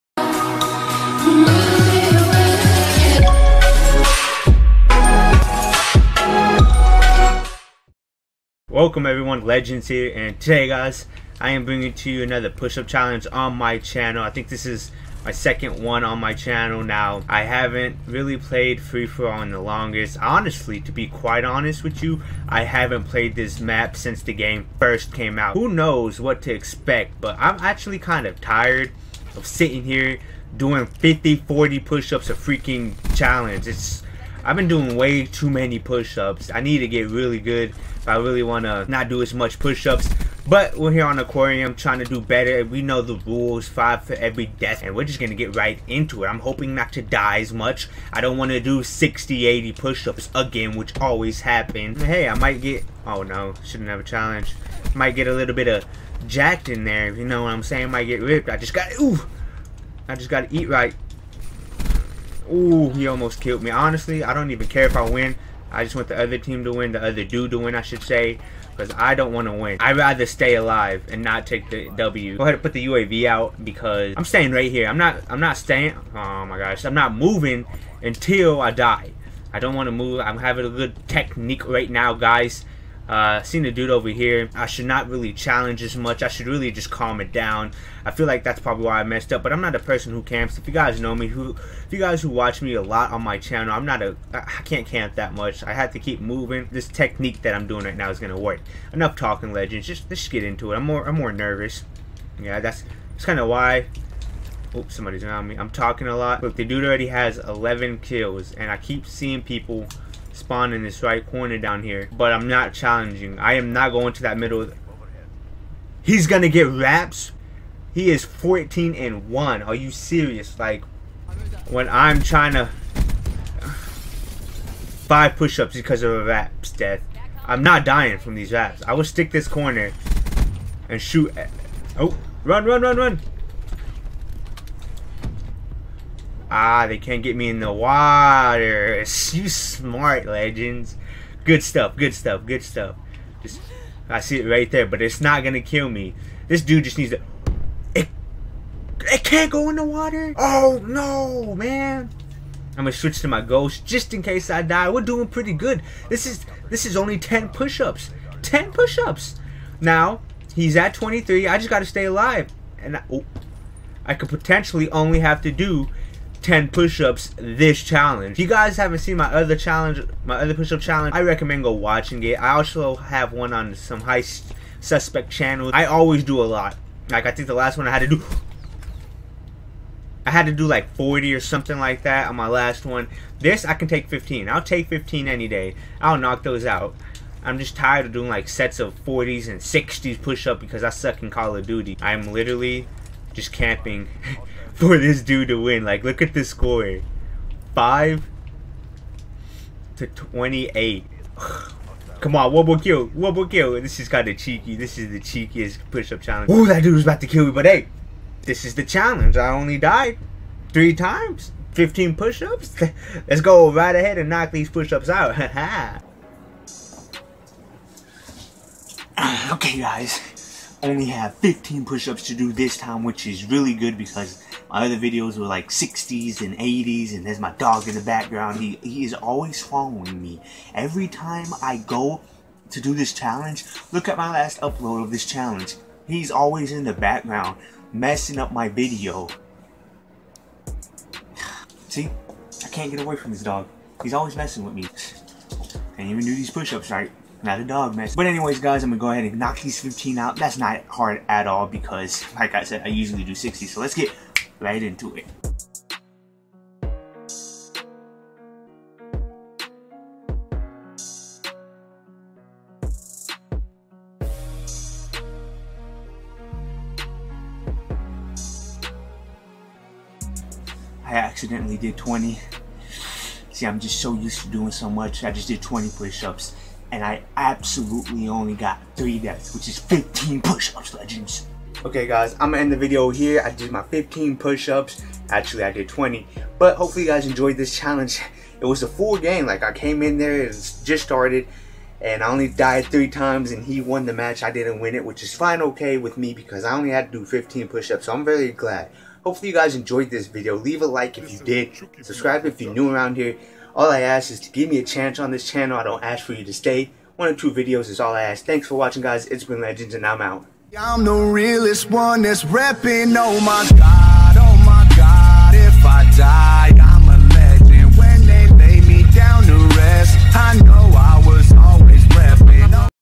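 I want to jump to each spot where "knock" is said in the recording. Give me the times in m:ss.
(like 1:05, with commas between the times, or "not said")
3:06, 3:34, 4:09.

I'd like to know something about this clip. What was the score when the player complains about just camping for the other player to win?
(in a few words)
5 to 28.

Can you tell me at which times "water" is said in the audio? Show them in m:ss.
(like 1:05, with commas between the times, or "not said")
2:17, 2:29.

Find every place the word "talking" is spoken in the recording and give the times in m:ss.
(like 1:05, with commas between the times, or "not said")
1:39, 1:45.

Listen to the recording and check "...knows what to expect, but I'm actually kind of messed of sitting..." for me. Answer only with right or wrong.
wrong.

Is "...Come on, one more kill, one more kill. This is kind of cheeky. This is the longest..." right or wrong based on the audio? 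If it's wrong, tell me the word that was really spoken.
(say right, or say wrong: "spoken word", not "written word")
wrong: "cheekiest", not "longest".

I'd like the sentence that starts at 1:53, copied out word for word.
I am not going to that middle.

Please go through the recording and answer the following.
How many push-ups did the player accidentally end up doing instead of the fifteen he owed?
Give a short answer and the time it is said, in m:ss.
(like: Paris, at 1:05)
20, at 4:31.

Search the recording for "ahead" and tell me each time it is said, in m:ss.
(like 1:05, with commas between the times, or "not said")
1:12, 3:33, 4:09.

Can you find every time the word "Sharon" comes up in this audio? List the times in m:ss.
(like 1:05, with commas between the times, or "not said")
not said.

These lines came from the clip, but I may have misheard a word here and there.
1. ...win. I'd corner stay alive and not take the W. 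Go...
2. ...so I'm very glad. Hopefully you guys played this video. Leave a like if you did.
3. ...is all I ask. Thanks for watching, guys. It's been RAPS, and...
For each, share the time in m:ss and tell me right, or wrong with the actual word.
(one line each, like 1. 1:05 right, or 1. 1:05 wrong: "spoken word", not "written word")
1. 1:09 wrong: "rather", not "corner"
2. 4:58 wrong: "enjoyed", not "played"
3. 5:07 wrong: "Legends", not "RAPS".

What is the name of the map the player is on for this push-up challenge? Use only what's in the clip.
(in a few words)
Aquarium.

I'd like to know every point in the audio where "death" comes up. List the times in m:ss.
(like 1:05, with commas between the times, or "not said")
0:44, 2:06, 4:39.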